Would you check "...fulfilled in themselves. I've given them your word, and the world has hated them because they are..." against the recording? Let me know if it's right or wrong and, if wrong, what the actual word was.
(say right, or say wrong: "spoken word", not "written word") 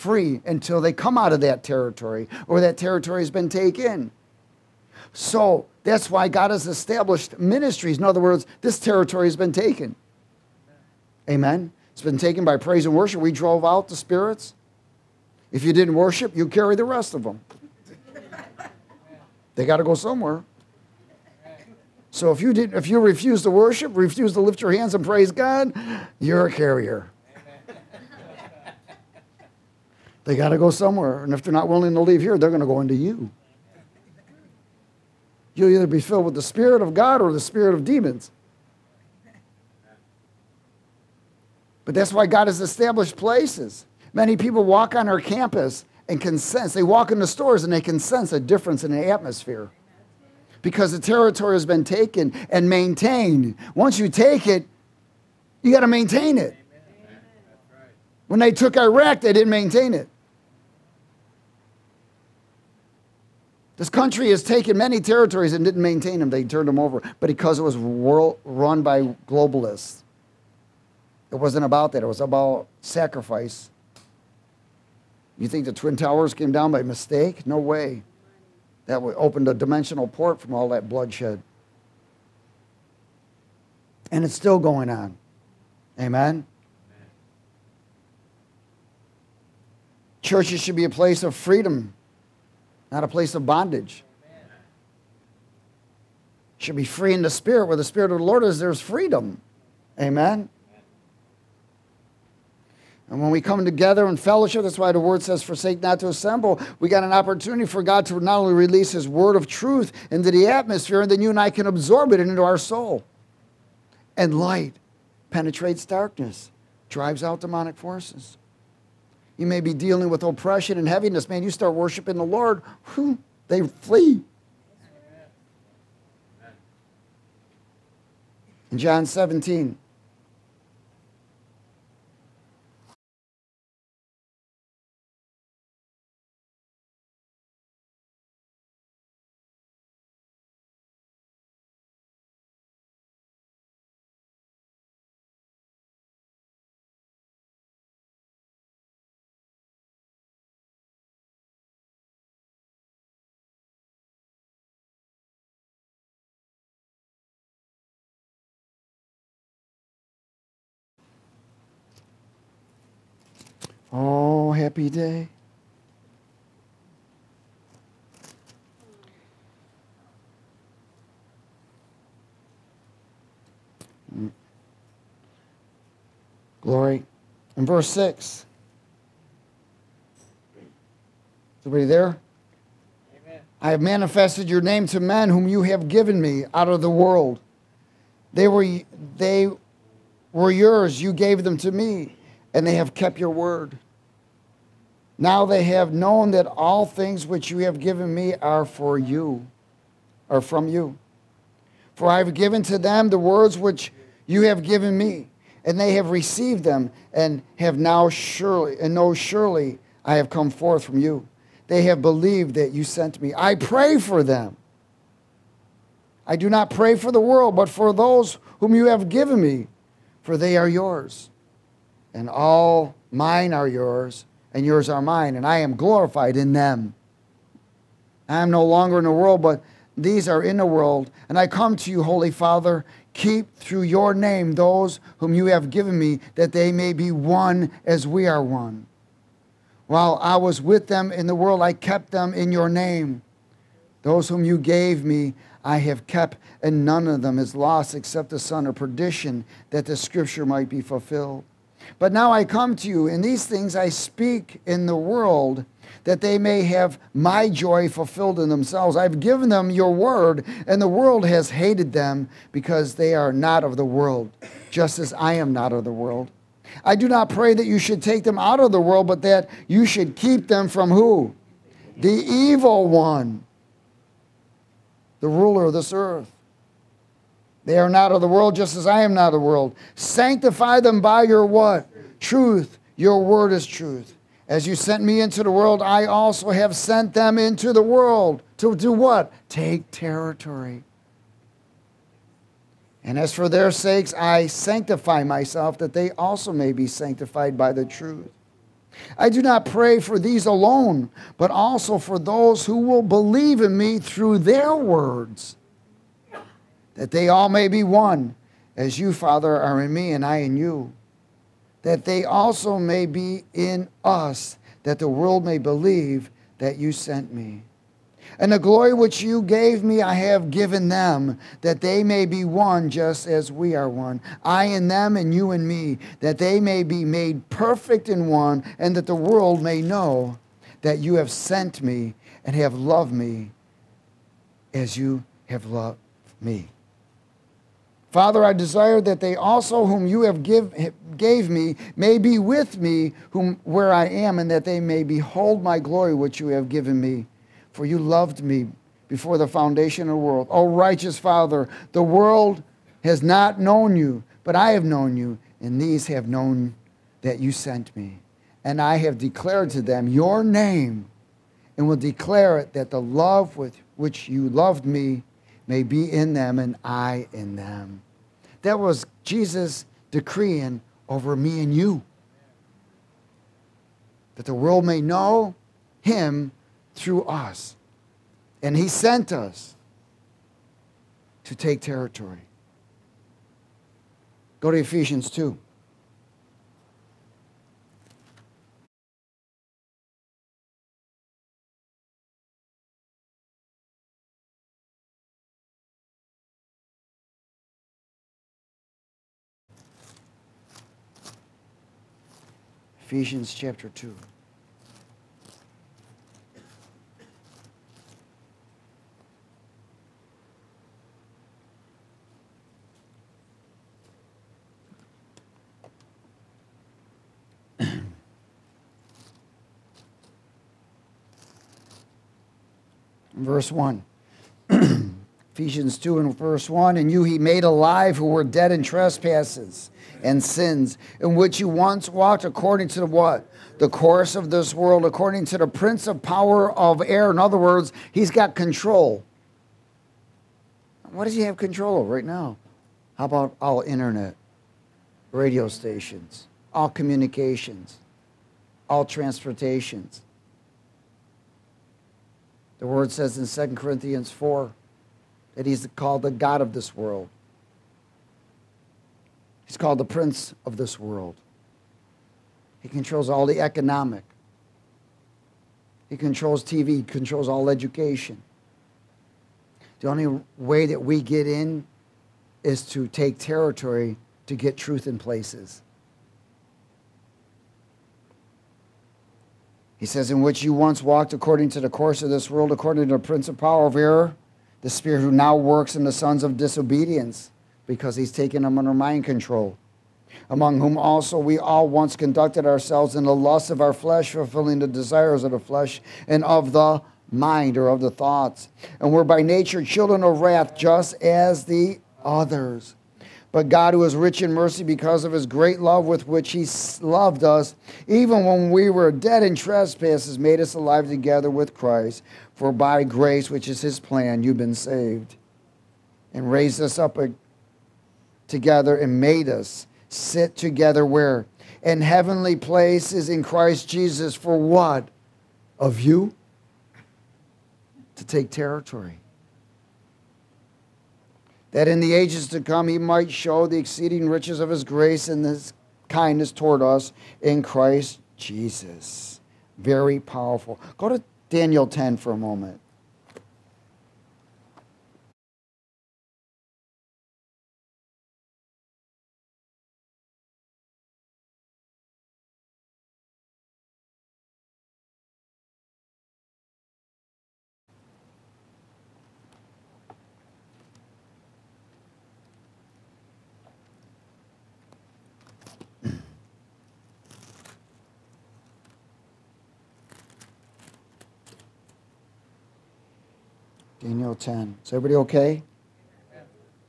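right.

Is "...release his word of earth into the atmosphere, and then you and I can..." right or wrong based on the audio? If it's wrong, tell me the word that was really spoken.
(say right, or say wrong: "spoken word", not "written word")
wrong: "truth", not "earth".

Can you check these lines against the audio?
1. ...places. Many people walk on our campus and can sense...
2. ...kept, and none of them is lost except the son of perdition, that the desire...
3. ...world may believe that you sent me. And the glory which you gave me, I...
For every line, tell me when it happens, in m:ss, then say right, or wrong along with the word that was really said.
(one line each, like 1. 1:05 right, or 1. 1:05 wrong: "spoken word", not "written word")
1. 0:43 right
2. 4:06 wrong: "scripture", not "desire"
3. 5:15 right.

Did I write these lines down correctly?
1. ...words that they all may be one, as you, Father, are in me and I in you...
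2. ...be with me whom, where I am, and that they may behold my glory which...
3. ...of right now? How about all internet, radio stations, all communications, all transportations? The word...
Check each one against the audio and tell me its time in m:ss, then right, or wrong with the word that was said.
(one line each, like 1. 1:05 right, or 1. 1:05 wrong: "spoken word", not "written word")
1. 5:04 right
2. 5:42 right
3. 7:22 right.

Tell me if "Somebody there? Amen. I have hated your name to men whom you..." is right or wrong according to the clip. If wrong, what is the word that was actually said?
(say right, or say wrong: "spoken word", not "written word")
wrong: "manifested", not "hated".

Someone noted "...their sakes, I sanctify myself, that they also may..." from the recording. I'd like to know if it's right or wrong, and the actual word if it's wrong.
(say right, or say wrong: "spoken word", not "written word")
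right.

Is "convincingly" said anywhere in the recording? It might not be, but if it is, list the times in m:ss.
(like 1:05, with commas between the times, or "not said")
not said.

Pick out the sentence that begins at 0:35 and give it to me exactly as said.
You'll either be filled with the Spirit of God or the Spirit of demons.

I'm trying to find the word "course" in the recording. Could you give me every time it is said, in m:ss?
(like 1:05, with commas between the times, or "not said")
7:13, 8:01.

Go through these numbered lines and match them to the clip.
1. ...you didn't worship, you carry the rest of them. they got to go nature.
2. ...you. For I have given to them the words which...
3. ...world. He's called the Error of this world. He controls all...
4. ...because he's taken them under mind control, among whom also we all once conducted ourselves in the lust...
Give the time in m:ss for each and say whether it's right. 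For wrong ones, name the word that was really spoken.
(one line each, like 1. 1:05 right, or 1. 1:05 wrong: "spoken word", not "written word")
1. 0:15 wrong: "somewhere", not "nature"
2. 3:20 right
3. 7:36 wrong: "Prince", not "Error"
4. 8:07 right.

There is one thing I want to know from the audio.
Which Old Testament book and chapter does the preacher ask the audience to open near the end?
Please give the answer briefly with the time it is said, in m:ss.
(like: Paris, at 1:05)
Daniel 10, at 9:01.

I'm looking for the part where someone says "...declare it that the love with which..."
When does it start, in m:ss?
6:01.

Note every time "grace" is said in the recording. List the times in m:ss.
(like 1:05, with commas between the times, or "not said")
8:33, 8:54.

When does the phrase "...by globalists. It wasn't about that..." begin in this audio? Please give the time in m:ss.
1:08.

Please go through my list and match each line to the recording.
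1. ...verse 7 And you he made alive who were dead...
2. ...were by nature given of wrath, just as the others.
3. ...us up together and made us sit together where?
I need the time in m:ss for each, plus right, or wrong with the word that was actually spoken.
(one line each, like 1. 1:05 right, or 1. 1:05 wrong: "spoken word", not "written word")
1. 7:06 wrong: "1", not "7"
2. 8:19 wrong: "children", not "given"
3. 8:36 right.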